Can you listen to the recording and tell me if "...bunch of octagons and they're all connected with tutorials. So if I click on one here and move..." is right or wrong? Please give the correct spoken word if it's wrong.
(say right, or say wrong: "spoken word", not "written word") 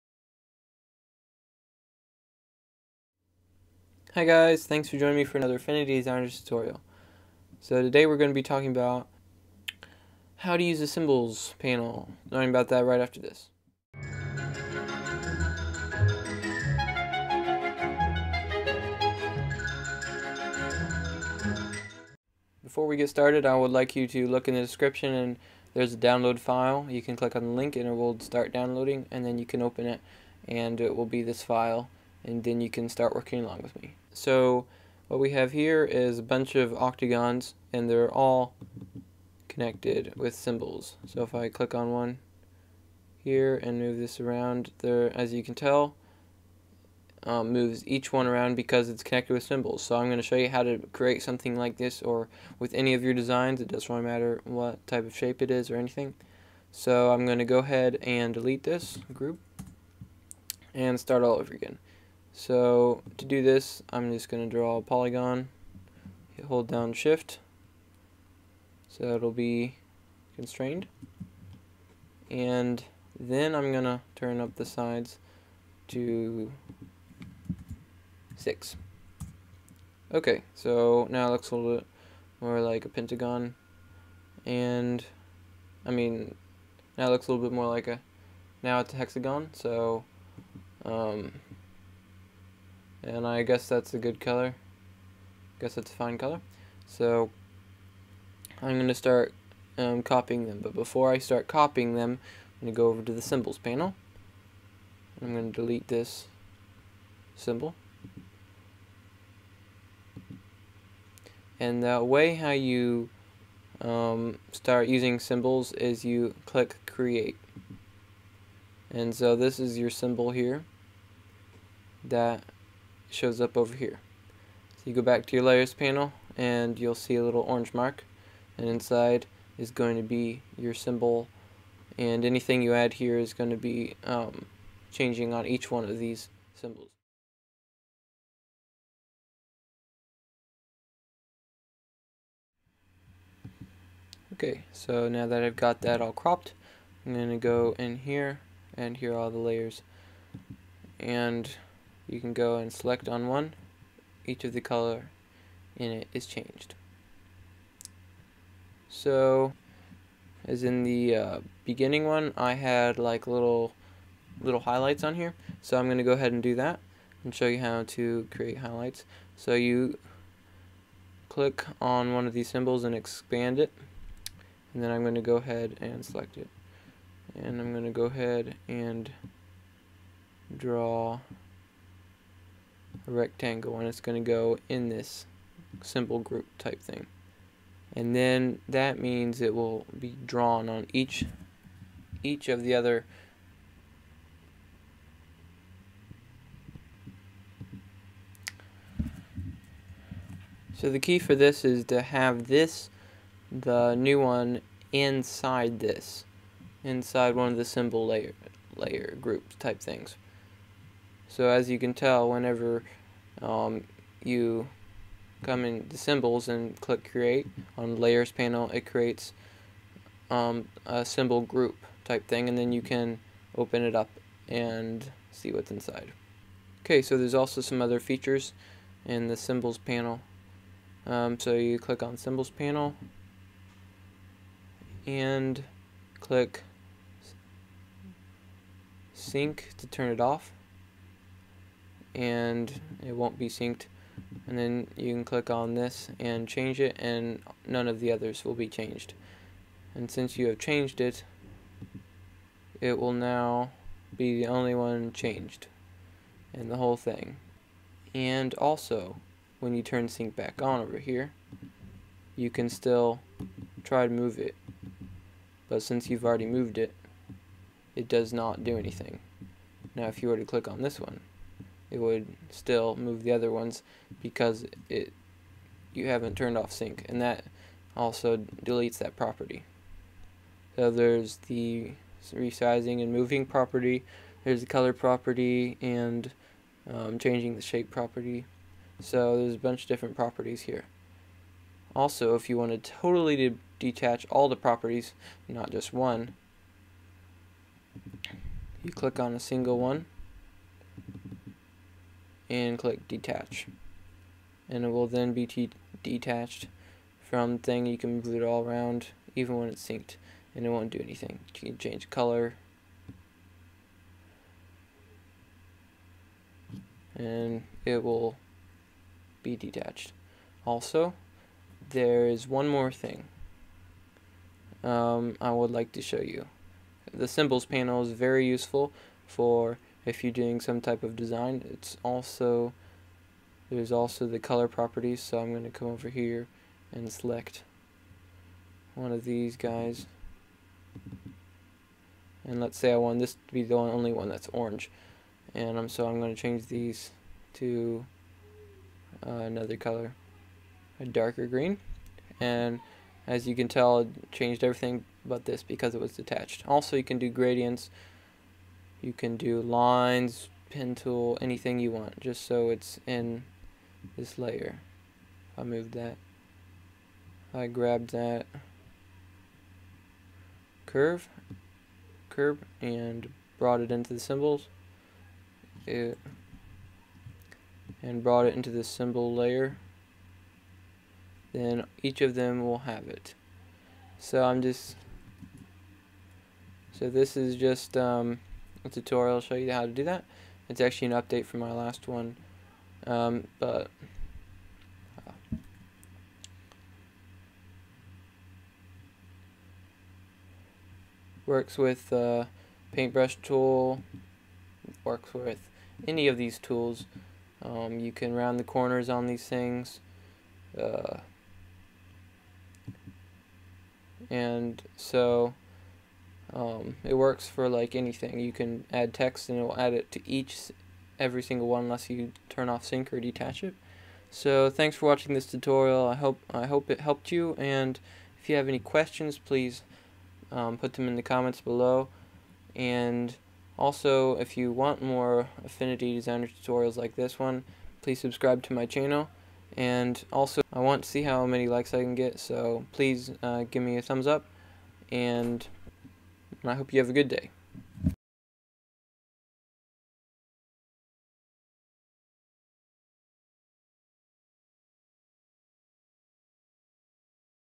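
wrong: "symbols", not "tutorials".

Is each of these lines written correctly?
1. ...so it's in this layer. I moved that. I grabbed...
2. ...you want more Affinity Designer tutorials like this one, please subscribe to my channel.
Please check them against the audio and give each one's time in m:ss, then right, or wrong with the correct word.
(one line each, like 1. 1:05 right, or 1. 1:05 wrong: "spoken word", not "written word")
1. 6:02 right
2. 7:14 right.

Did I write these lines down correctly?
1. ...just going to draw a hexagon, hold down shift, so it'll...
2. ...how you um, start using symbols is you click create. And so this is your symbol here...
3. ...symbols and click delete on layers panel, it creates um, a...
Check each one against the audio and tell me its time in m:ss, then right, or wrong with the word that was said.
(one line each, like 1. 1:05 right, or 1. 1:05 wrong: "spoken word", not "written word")
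1. 1:04 wrong: "polygon", not "hexagon"
2. 1:52 right
3. 3:35 wrong: "create", not "delete".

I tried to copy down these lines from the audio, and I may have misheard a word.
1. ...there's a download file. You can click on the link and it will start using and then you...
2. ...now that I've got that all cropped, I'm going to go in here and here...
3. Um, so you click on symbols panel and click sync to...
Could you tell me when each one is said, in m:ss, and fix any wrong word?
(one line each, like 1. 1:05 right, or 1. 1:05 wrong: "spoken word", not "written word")
1. 0:25 wrong: "downloading", not "using"
2. 2:25 right
3. 3:51 right.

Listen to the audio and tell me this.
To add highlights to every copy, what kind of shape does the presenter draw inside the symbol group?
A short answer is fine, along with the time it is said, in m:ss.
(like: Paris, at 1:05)
rectangle, at 3:03.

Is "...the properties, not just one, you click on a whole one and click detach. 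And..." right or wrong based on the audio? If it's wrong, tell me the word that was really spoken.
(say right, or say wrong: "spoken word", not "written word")
wrong: "single", not "whole".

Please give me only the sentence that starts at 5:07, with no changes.
You can move it all around even when it's synced and it won't do anything.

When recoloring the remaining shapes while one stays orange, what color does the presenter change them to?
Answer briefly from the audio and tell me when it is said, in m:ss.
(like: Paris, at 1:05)
darker green, at 5:50.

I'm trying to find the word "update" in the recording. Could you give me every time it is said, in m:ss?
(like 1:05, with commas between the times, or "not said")
6:31.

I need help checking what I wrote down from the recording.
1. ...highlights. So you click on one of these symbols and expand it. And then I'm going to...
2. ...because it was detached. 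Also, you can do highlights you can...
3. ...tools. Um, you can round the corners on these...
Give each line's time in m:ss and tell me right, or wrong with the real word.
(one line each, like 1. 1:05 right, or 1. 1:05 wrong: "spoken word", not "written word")
1. 2:48 right
2. 5:55 wrong: "gradients", not "highlights"
3. 6:46 right.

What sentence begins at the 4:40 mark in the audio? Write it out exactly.
So there's the resizing and moving property, there's the color property and um, changing the shape property.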